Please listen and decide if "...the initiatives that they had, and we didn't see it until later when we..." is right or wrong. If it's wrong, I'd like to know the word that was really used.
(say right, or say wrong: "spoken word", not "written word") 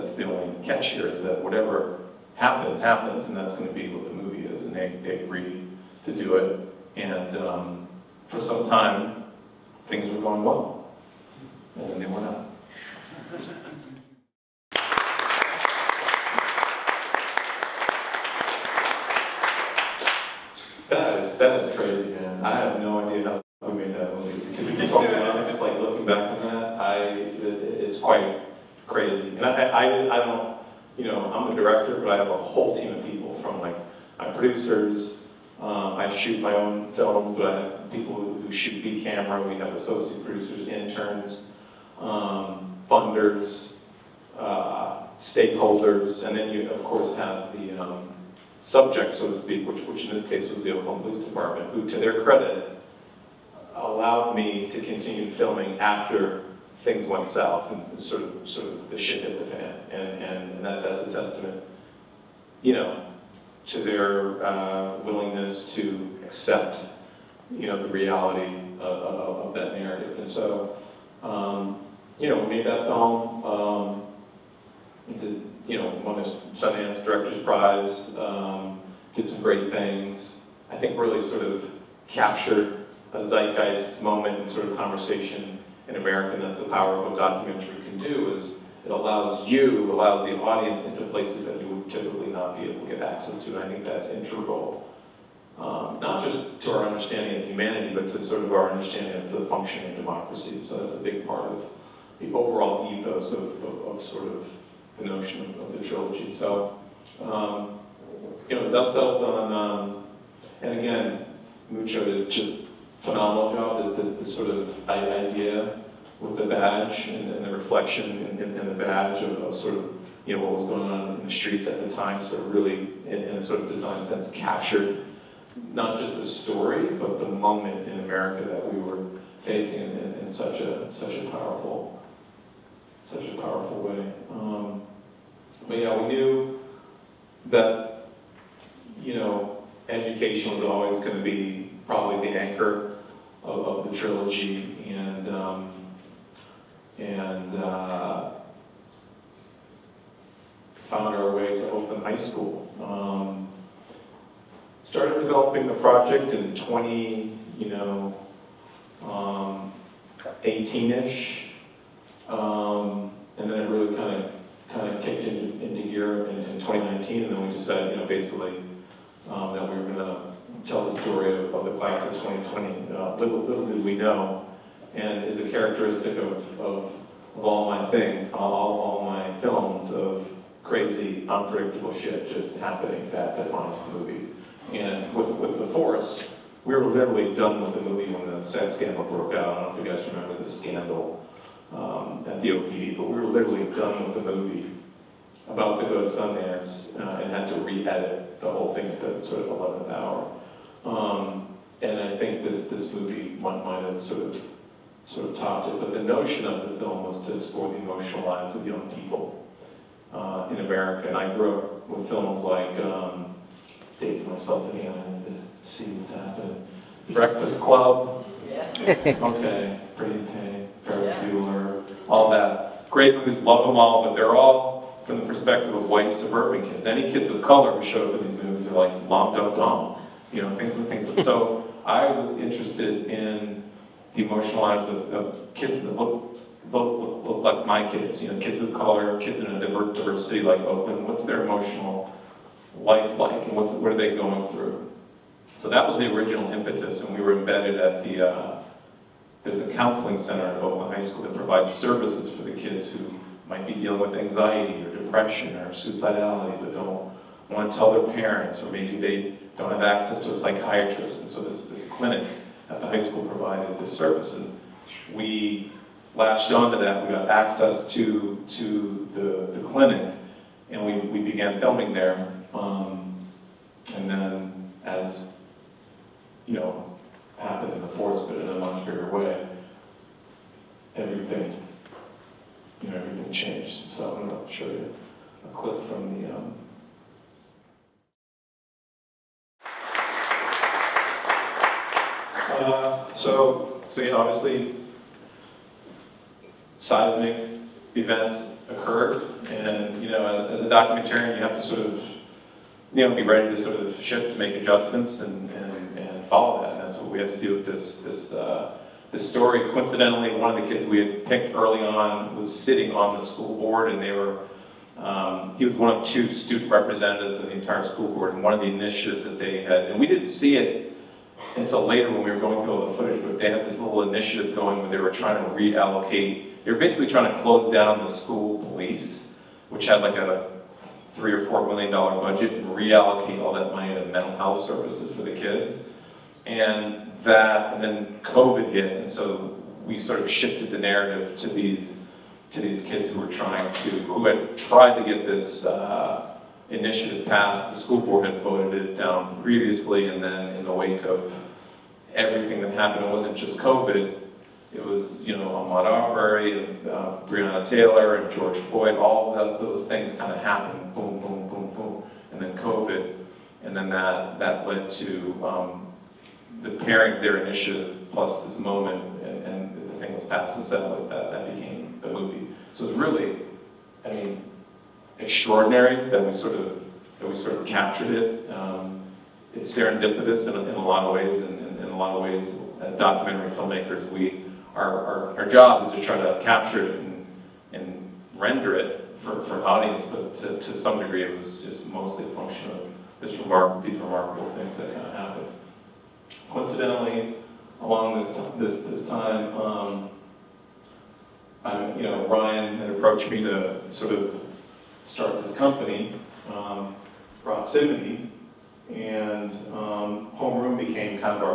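right.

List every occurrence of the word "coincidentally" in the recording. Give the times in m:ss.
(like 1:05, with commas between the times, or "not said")
5:09, 6:36.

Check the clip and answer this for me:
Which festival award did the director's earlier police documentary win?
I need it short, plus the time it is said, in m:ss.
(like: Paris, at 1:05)
Sundance Director's Prize, at 1:16.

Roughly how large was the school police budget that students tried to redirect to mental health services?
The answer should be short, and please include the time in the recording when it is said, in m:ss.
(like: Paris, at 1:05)
3 or 4 million dollars, at 5:31.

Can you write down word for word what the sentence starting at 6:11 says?
that, that, that became the movie.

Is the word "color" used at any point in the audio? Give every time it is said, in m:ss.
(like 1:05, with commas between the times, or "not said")
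3:47, 3:58.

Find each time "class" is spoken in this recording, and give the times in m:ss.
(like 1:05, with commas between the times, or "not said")
2:51.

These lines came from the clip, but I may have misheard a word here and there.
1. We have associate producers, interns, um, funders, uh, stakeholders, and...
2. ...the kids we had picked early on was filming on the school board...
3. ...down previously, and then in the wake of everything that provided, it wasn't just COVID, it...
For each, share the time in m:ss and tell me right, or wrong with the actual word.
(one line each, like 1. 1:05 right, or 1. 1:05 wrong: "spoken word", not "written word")
1. 0:39 right
2. 5:10 wrong: "sitting", not "filming"
3. 5:48 wrong: "happened", not "provided".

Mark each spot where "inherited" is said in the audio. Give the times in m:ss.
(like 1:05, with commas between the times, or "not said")
not said.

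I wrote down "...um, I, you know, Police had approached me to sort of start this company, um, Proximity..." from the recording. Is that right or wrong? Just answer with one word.
wrong.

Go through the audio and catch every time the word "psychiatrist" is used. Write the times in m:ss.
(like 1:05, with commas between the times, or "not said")
4:20.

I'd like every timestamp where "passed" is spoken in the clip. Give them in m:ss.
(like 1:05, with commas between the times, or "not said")
5:47, 6:10.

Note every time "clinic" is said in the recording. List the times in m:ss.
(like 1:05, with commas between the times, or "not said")
4:21, 4:29.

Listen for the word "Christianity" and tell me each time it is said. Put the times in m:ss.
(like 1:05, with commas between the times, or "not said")
not said.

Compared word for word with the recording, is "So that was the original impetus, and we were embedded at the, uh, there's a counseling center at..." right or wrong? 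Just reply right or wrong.
right.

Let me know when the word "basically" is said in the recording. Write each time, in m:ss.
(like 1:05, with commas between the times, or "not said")
2:48, 5:26.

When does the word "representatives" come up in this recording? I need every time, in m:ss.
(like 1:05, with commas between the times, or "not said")
5:16.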